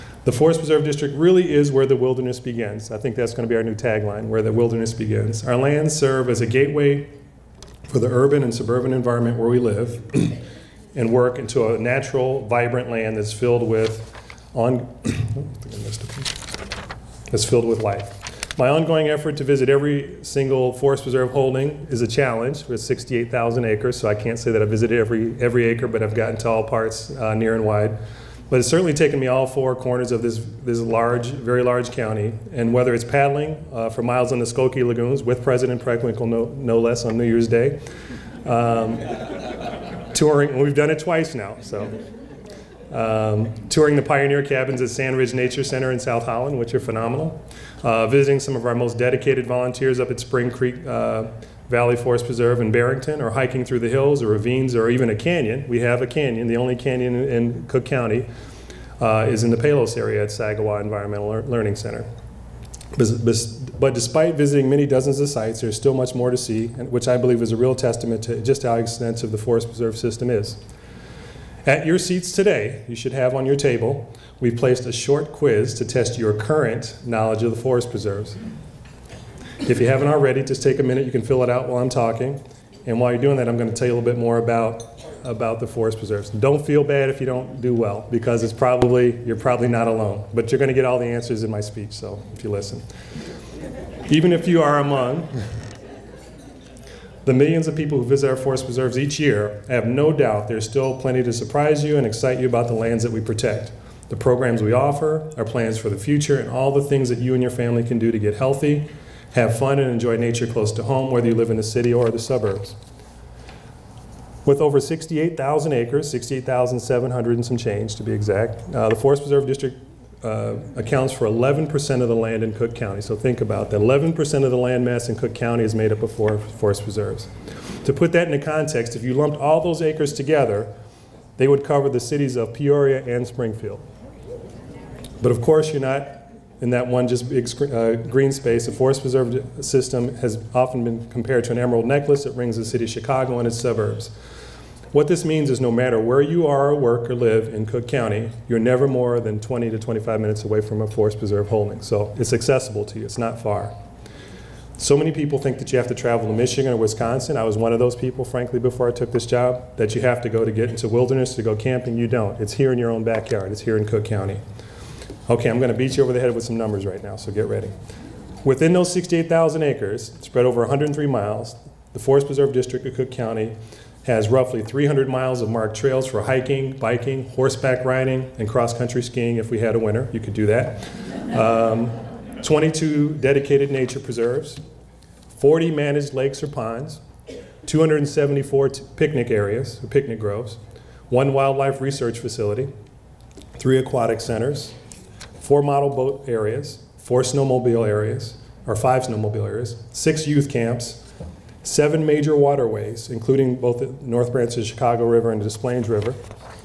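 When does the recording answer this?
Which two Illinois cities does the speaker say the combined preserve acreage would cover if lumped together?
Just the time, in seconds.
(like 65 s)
132 s.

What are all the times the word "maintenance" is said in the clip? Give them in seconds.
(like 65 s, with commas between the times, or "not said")
not said.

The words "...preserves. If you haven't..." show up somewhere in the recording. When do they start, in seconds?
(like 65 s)
77 s.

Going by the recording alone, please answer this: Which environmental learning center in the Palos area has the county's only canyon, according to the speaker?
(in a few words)
Sagawau.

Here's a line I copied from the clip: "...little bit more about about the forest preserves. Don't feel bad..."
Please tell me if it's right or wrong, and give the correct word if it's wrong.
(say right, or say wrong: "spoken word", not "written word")
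right.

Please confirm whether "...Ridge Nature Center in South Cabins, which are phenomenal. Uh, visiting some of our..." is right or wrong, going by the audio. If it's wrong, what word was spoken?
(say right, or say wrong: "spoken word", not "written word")
wrong: "Holland", not "Cabins".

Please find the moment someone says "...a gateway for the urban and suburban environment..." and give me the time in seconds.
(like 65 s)
6 s.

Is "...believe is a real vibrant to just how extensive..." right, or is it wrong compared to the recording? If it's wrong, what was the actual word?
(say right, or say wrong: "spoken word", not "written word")
wrong: "testament", not "vibrant".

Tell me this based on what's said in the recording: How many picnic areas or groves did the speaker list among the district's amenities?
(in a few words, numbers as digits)
274.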